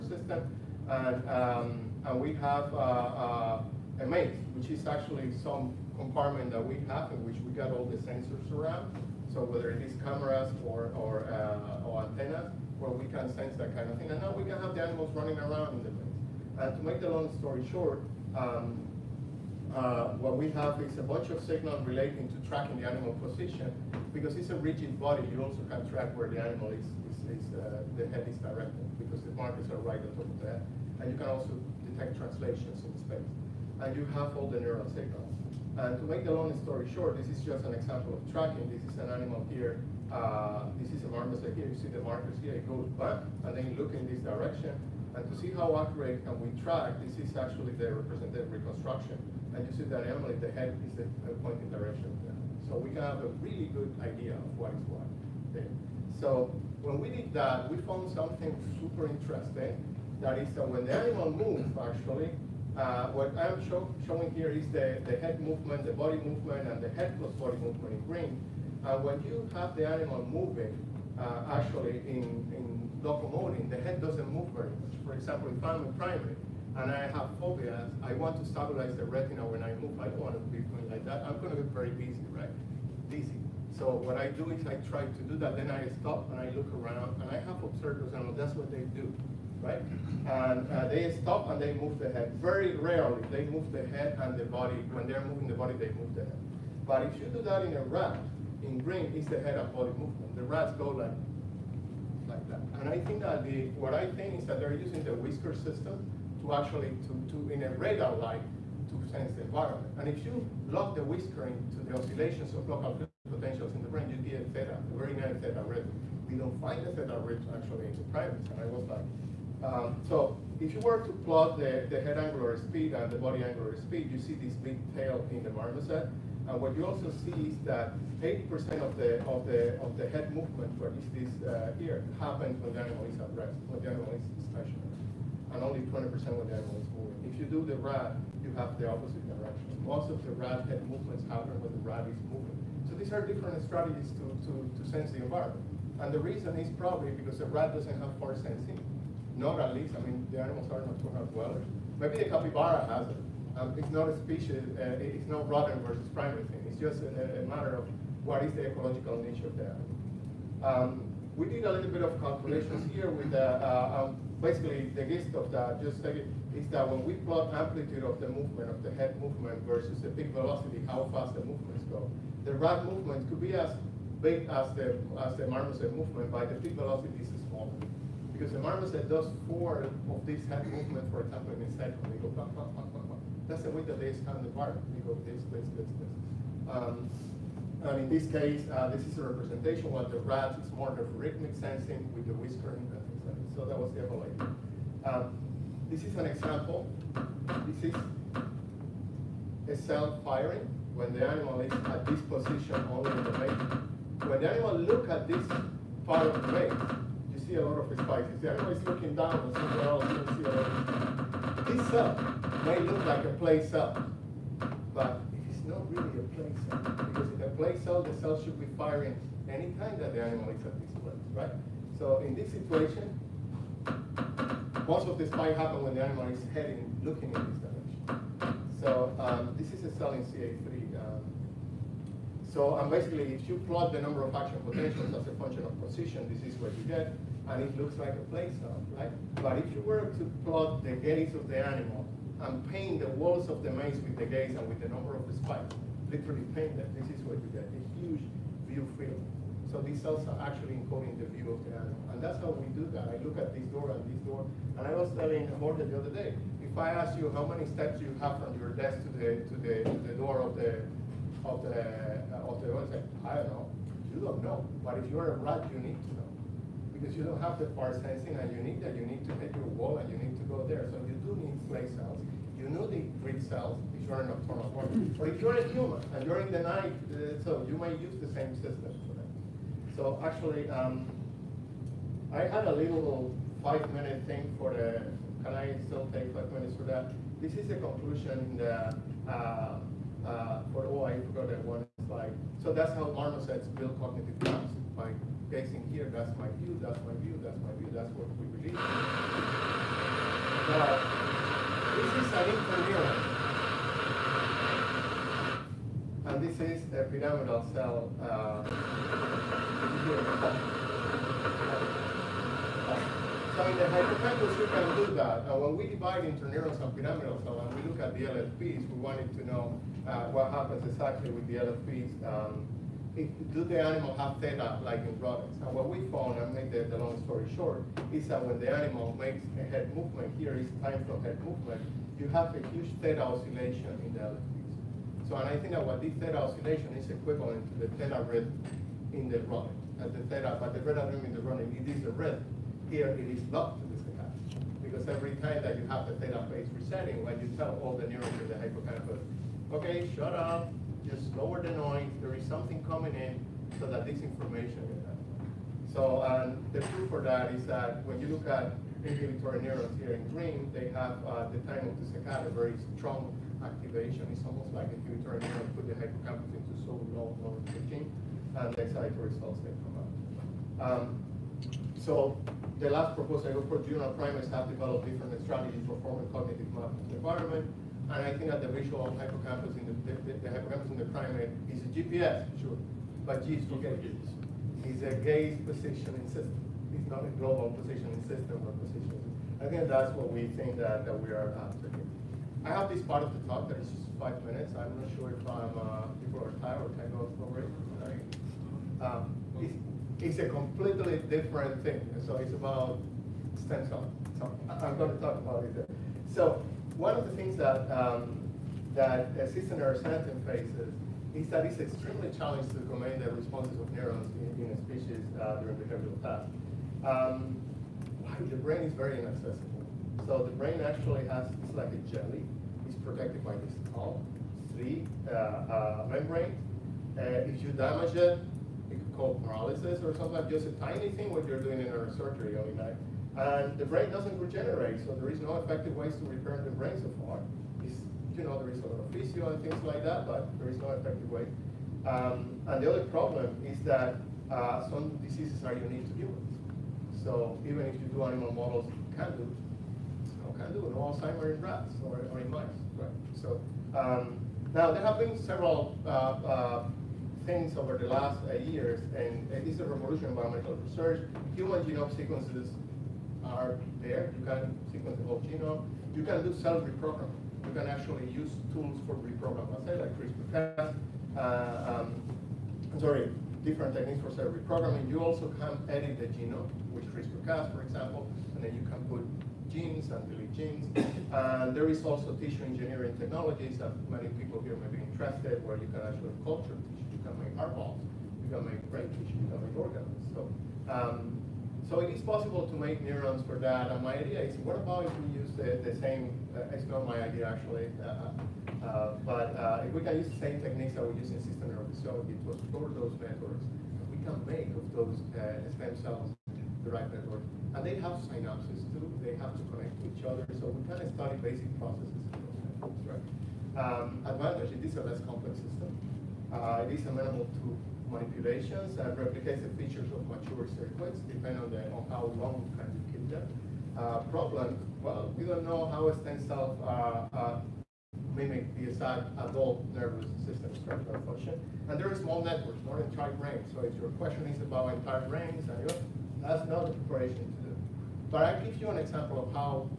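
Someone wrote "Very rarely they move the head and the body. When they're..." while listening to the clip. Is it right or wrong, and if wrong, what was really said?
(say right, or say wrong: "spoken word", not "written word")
right.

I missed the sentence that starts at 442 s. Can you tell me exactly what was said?
Um, and the other problem is that uh, some diseases are unique to humans.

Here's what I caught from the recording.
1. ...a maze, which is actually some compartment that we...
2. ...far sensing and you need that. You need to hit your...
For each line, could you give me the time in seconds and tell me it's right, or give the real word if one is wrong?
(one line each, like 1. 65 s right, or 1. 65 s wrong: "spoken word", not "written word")
1. 4 s right
2. 267 s right.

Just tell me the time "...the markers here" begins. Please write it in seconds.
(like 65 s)
41 s.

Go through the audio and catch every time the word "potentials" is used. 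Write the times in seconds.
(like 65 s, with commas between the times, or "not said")
113 s, 234 s.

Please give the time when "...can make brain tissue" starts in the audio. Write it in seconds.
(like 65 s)
488 s.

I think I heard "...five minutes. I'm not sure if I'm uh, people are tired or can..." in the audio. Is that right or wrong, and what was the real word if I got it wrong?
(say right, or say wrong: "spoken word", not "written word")
right.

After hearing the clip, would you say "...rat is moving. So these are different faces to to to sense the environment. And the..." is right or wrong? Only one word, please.
wrong.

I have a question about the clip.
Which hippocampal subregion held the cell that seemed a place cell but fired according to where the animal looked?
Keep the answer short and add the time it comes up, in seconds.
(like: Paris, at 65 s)
CA3, at 230 s.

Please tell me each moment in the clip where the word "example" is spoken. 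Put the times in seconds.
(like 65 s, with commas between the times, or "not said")
37 s, 75 s, 181 s, 196 s, 477 s, 538 s.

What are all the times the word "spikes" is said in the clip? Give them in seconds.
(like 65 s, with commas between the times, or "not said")
207 s, 225 s, 245 s.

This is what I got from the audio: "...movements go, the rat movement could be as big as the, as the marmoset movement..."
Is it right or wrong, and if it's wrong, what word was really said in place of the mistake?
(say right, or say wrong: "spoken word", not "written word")
right.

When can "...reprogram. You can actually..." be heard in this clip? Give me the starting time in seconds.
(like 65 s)
466 s.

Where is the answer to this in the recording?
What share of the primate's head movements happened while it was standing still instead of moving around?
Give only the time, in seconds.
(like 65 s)
128 s.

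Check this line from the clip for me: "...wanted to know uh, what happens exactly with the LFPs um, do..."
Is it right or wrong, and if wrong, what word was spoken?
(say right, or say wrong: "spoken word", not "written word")
right.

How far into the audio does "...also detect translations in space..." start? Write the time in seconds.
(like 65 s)
31 s.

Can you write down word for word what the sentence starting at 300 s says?
But this is an interneuron, And this is a pyramidal cell uh, So in the hypothalamus, you can do that.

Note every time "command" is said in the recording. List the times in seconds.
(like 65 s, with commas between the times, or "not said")
412 s.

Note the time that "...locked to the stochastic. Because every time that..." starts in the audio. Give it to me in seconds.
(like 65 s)
343 s.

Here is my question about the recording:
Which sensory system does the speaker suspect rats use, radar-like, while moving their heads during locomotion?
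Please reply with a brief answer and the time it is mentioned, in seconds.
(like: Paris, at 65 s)
Whisker system, at 105 s.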